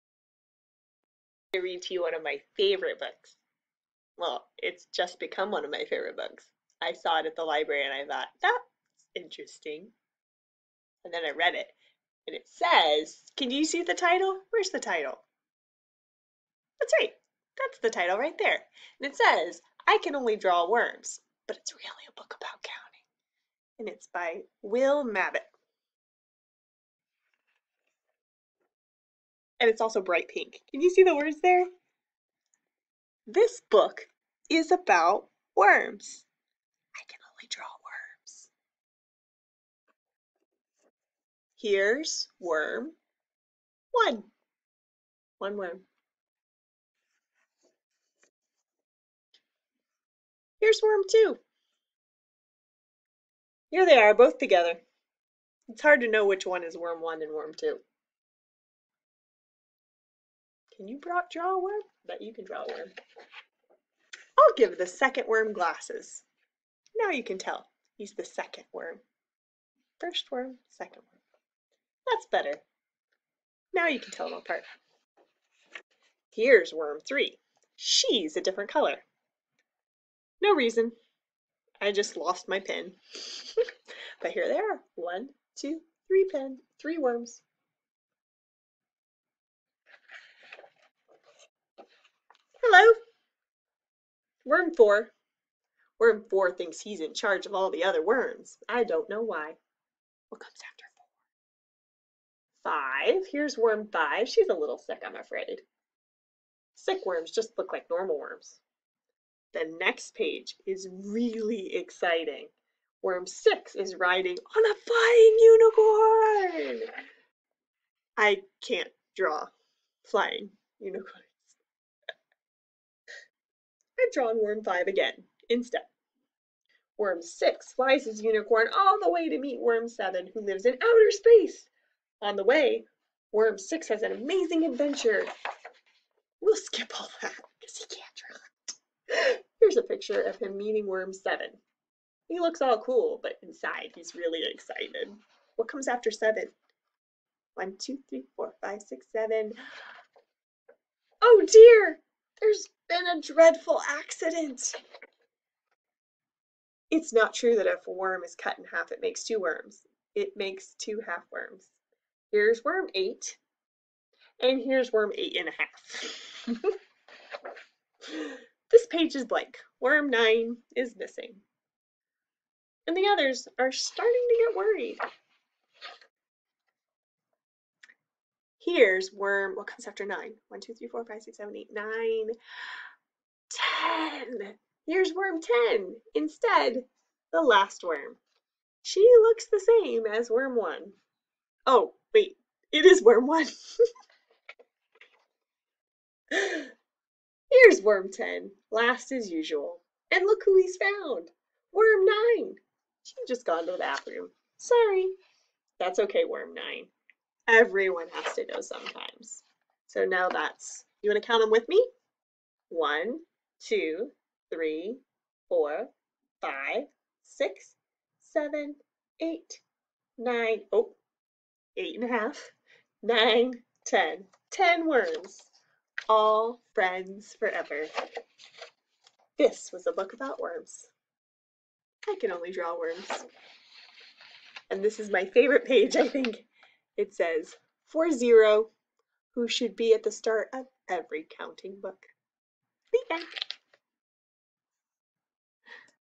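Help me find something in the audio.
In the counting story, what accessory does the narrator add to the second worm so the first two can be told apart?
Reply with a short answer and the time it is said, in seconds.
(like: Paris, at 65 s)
Glasses, at 65 s.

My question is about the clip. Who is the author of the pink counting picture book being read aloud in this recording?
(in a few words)
Will Mabbitt.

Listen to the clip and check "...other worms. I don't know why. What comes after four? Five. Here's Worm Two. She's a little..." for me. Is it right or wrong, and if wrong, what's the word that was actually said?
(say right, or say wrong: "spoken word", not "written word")
wrong: "Five", not "Two".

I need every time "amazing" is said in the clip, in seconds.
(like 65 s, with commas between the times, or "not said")
134 s.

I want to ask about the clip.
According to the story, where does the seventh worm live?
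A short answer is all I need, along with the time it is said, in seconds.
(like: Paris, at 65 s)
Outer space, at 130 s.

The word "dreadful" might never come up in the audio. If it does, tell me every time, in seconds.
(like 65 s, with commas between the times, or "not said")
153 s.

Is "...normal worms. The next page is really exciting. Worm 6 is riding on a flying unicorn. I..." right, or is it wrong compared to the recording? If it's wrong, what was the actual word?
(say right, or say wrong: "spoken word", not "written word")
right.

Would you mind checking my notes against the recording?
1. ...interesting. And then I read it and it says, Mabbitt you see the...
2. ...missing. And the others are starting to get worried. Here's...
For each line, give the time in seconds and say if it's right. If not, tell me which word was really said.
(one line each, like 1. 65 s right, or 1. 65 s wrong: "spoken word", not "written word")
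1. 9 s wrong: "Can", not "Mabbitt"
2. 170 s right.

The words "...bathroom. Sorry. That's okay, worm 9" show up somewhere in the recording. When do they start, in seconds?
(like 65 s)
203 s.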